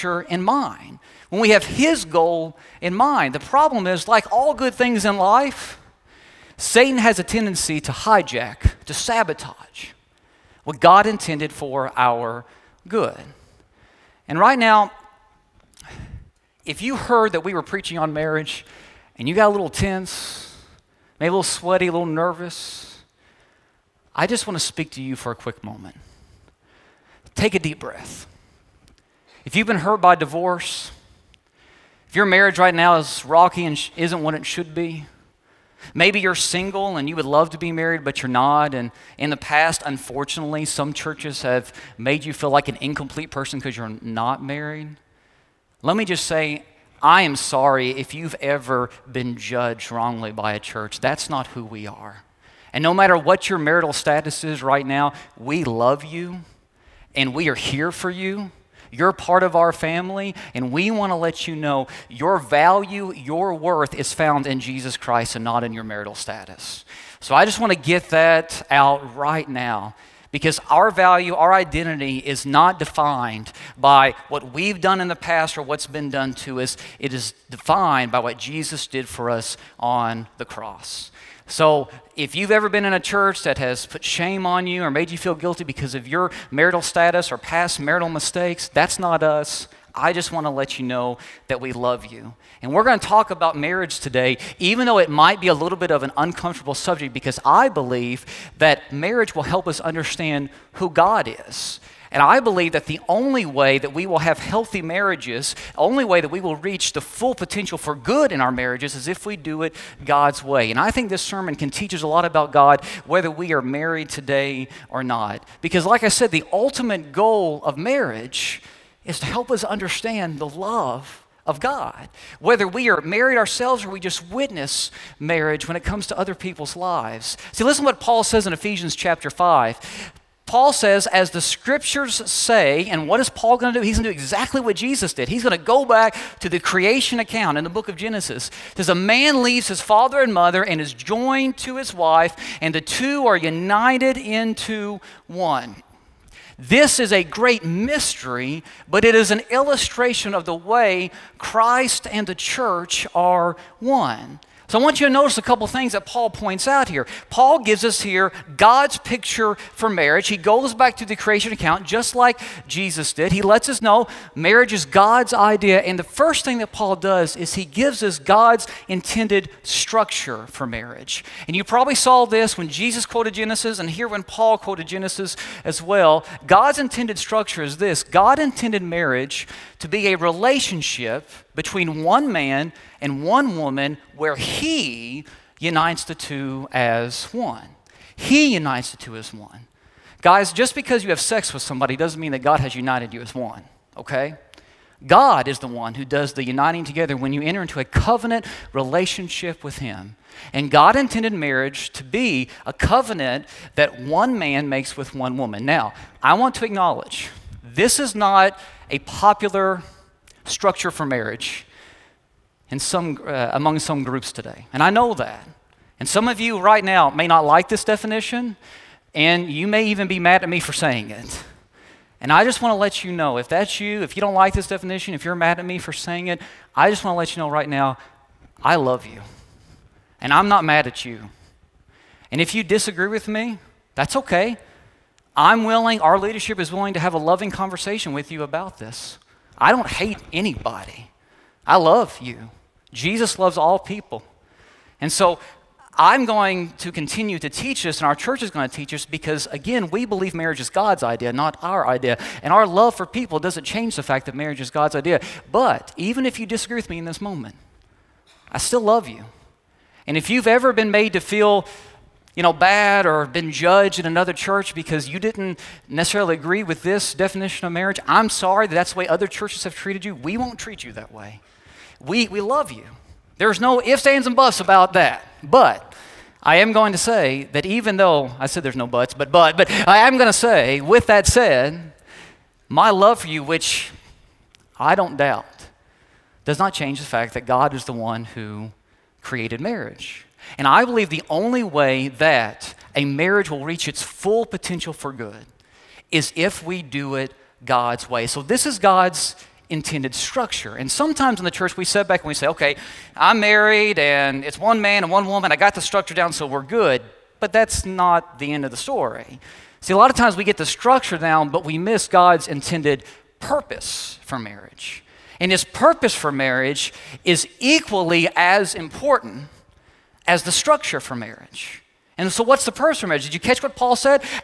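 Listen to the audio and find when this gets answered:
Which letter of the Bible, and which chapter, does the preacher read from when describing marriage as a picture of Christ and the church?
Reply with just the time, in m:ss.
2:08.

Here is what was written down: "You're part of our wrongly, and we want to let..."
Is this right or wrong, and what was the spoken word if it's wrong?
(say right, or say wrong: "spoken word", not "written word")
wrong: "family", not "wrongly".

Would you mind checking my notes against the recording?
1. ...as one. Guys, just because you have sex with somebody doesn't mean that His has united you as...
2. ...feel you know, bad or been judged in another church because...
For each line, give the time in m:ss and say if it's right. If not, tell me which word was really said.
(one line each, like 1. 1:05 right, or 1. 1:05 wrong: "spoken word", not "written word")
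1. 3:09 wrong: "God", not "His"
2. 4:21 right.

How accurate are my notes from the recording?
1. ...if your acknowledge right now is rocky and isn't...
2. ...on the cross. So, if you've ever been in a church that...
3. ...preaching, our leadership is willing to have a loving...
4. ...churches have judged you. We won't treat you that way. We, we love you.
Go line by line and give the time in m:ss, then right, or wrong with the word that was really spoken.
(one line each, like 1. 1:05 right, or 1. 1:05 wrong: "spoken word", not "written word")
1. 0:32 wrong: "marriage", not "acknowledge"
2. 1:19 right
3. 3:55 wrong: "willing", not "preaching"
4. 4:29 wrong: "treated", not "judged".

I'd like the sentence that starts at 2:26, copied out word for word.
This is a great mystery, but it is an illustration of the way Christ and the church are one.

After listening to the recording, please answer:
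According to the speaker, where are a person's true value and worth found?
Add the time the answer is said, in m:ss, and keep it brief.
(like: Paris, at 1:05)
Jesus Christ, at 1:04.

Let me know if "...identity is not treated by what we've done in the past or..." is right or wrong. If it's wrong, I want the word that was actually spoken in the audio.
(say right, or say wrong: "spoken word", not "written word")
wrong: "defined", not "treated".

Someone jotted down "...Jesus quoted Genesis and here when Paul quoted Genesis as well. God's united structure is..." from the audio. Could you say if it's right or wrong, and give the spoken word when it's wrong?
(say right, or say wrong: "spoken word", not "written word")
wrong: "intended", not "united".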